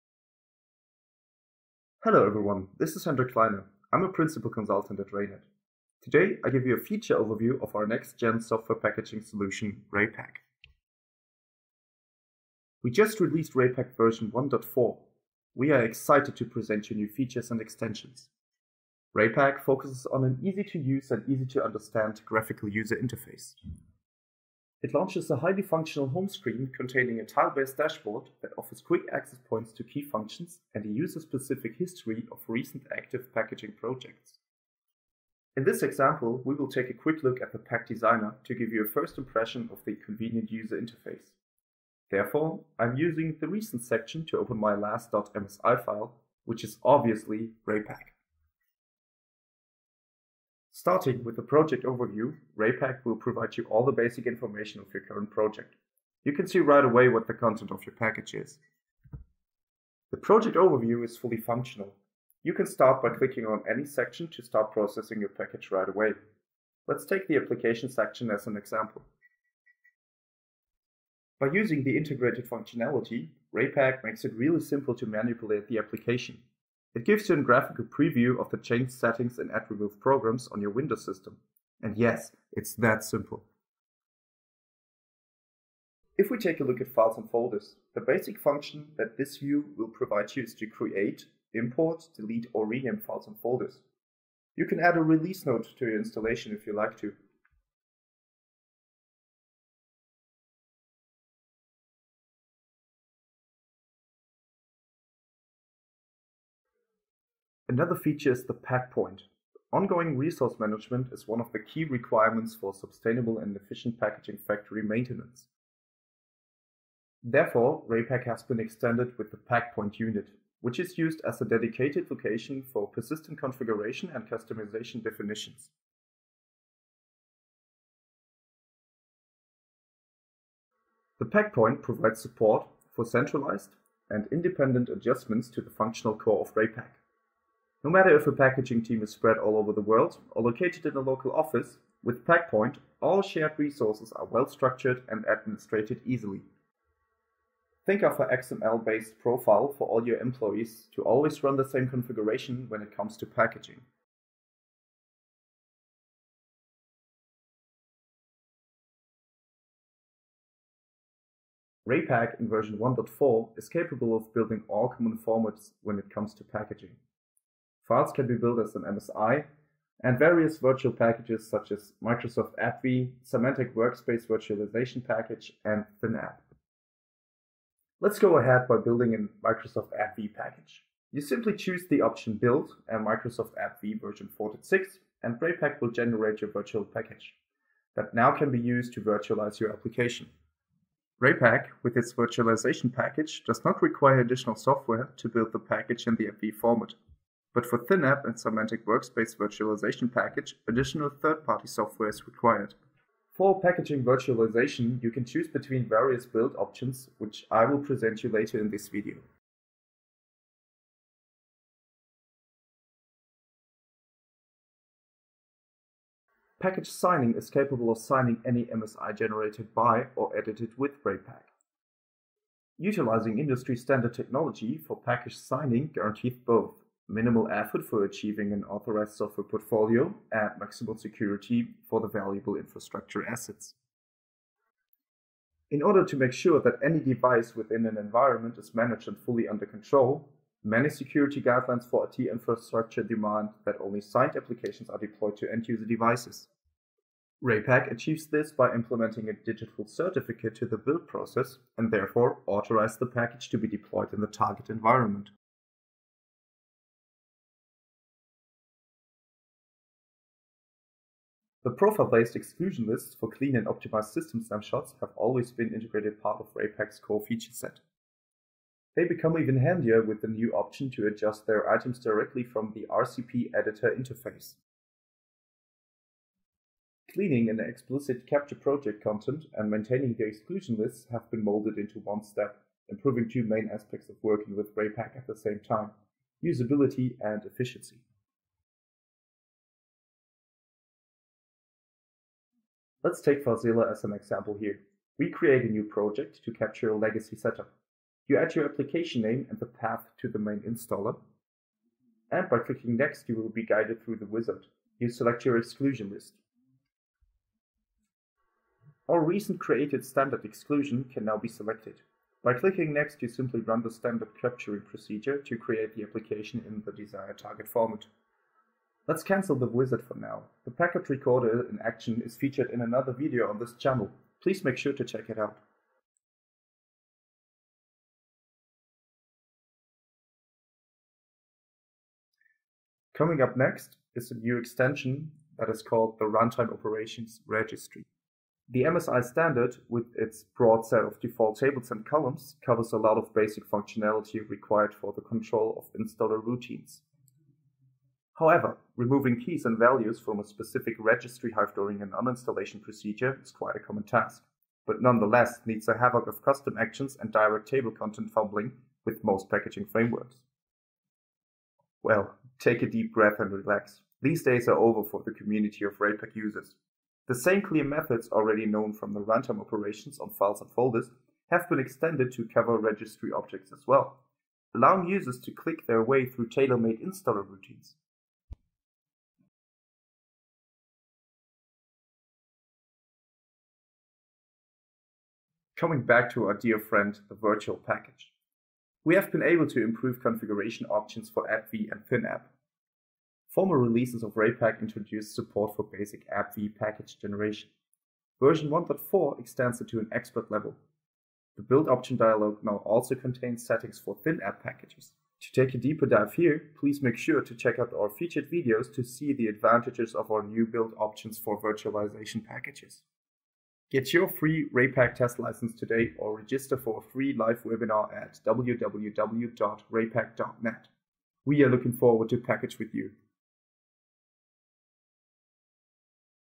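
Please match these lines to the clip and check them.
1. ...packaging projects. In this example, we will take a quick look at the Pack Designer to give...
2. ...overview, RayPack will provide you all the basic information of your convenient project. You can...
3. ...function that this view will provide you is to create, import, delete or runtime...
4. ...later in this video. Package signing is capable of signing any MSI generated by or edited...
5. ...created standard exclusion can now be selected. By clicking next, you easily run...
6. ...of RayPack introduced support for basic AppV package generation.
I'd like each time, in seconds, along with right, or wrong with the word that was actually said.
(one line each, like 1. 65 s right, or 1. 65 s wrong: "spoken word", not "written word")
1. 33 s right
2. 51 s wrong: "current", not "convenient"
3. 88 s wrong: "rename", not "runtime"
4. 208 s right
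5. 309 s wrong: "simply", not "easily"
6. 394 s right.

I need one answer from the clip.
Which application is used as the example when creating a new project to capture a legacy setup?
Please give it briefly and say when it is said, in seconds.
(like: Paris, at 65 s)
Filezilla, at 293 s.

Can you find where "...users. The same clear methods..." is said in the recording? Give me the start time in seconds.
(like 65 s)
366 s.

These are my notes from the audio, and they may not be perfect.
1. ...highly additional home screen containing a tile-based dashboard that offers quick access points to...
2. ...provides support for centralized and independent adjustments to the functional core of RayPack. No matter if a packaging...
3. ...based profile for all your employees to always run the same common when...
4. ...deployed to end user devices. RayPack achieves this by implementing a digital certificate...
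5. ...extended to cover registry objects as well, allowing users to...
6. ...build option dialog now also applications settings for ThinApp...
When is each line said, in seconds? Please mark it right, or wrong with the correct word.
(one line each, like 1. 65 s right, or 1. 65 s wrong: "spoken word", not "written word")
1. 25 s wrong: "functional", not "additional"
2. 131 s right
3. 148 s wrong: "configuration", not "common"
4. 244 s right
5. 371 s right
6. 401 s wrong: "contains", not "applications".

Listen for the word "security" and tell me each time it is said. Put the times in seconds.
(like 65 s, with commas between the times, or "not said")
230 s, 240 s.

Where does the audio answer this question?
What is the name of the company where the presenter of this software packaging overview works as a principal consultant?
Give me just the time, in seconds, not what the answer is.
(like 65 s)
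5 s.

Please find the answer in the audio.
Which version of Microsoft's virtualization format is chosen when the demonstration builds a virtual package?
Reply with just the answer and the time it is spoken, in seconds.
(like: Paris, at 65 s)
4.6, at 184 s.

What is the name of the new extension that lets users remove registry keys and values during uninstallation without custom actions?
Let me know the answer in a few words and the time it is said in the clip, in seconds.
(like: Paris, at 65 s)
Runtime Operations Registry, at 336 s.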